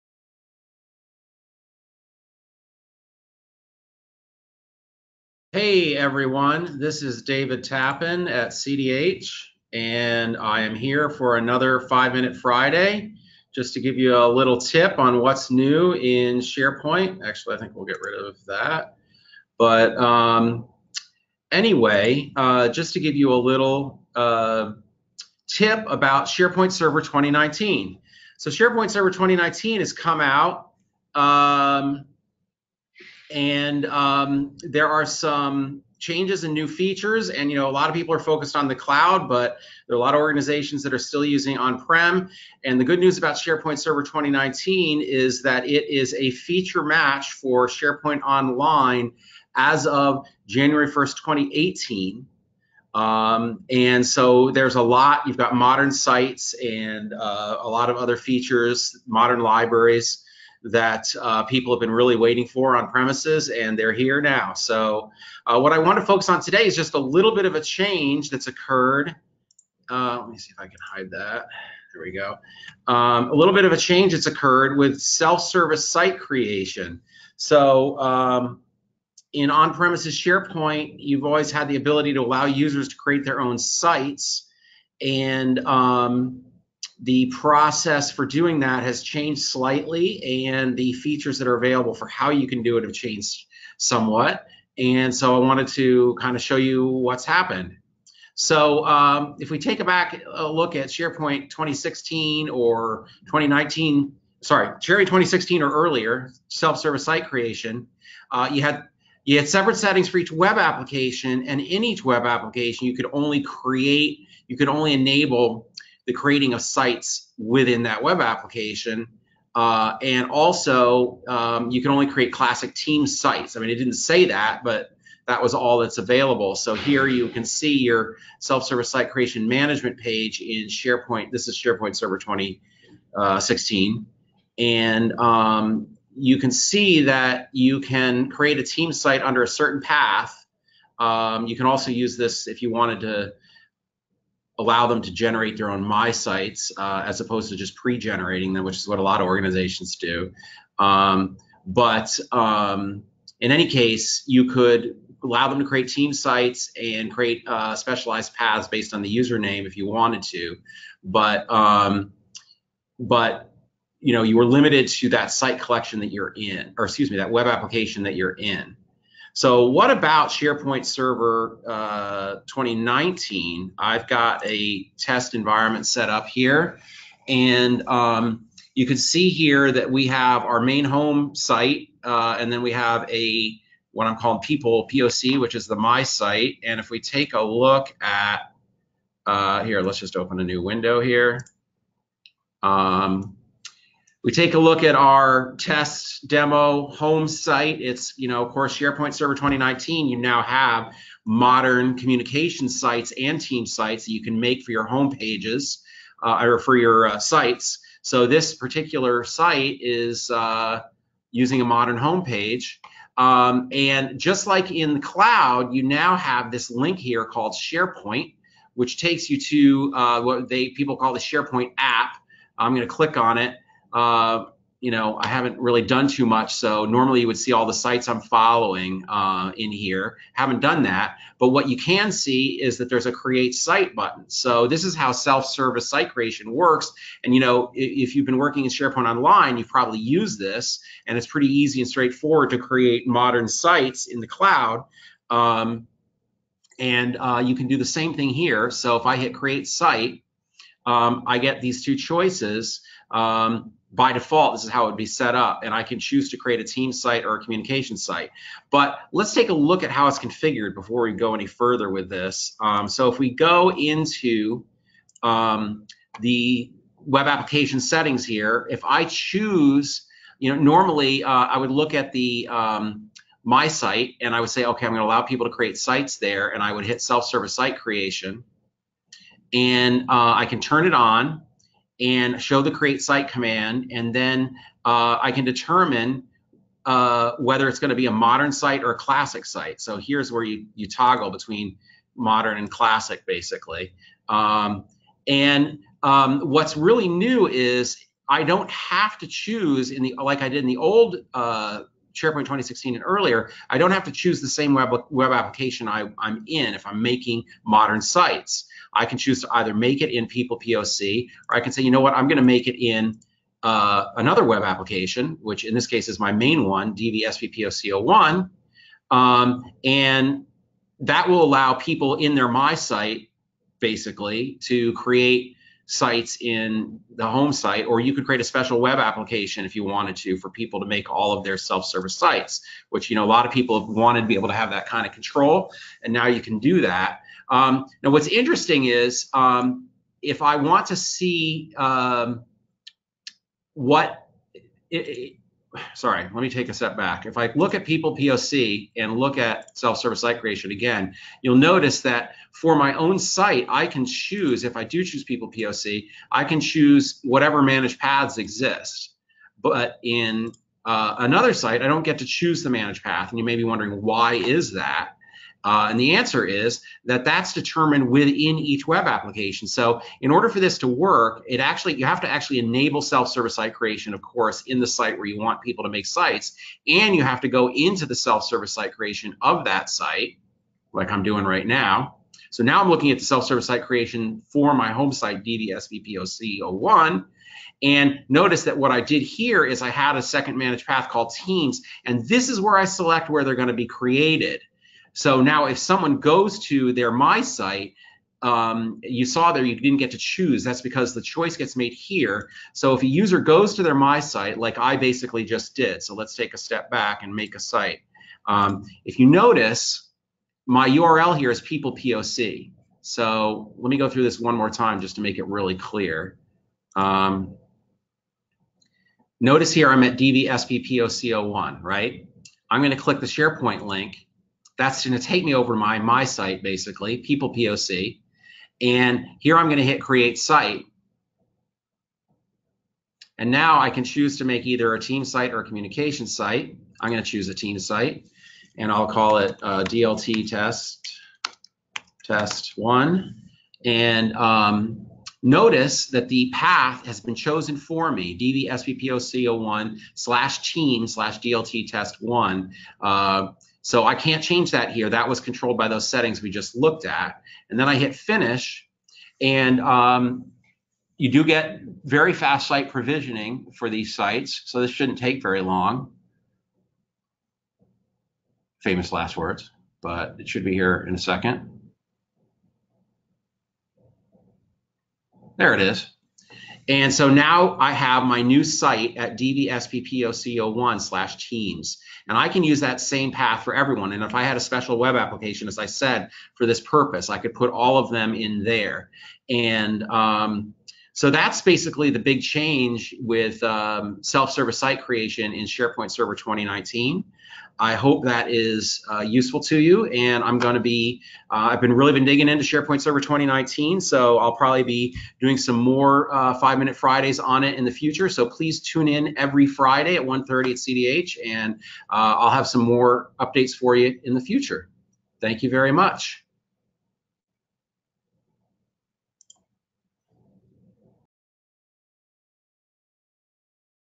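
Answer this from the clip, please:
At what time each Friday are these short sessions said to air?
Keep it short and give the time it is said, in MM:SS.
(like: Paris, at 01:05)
1:30, at 08:30.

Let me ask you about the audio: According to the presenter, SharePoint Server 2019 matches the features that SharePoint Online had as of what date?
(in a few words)
January 1st 2018.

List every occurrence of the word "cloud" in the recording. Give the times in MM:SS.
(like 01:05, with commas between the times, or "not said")
00:38, 03:34, 04:04.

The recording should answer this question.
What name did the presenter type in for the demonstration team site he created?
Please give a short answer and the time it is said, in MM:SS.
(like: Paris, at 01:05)
DLT test one, at 07:19.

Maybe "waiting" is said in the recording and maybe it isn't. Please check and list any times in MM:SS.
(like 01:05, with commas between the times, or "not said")
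01:02.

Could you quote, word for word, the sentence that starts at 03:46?
So normally you would see all the sites I'm following uh, in here.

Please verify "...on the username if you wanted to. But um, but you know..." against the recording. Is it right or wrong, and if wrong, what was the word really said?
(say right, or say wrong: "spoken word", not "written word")
right.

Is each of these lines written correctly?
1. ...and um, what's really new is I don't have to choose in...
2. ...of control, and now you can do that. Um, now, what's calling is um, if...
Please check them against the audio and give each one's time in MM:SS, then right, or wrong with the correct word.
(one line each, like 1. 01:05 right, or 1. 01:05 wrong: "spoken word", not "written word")
1. 04:55 right
2. 05:35 wrong: "interesting", not "calling".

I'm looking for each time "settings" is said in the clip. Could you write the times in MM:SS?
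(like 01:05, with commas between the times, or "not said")
01:49, 04:27, 07:36.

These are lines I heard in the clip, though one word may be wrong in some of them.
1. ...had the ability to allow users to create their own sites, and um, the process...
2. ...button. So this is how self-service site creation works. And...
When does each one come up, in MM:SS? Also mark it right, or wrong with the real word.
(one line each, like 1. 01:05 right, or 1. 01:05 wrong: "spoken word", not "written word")
1. 01:21 right
2. 03:53 right.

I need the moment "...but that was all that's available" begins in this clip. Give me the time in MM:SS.
02:04.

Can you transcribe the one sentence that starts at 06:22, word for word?
So now I'm looking at the self-service site creation for my home site DDSVPOC01.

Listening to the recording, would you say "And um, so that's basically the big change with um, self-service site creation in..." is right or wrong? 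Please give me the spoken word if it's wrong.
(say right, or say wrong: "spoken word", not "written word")
right.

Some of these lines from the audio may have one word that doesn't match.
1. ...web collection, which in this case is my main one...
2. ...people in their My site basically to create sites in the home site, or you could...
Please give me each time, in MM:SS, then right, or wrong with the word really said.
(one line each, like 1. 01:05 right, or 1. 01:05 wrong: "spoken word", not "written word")
1. 05:14 wrong: "application", not "collection"
2. 05:21 right.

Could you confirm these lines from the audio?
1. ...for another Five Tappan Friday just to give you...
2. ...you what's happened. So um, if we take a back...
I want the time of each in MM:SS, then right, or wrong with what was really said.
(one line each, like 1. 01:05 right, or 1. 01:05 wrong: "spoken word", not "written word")
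1. 00:11 wrong: "Minute", not "Tappan"
2. 01:36 right.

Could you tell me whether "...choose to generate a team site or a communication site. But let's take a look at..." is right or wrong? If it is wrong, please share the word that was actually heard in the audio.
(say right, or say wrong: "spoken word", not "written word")
wrong: "create", not "generate".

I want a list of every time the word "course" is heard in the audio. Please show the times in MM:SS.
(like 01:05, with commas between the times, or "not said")
03:18, 06:14.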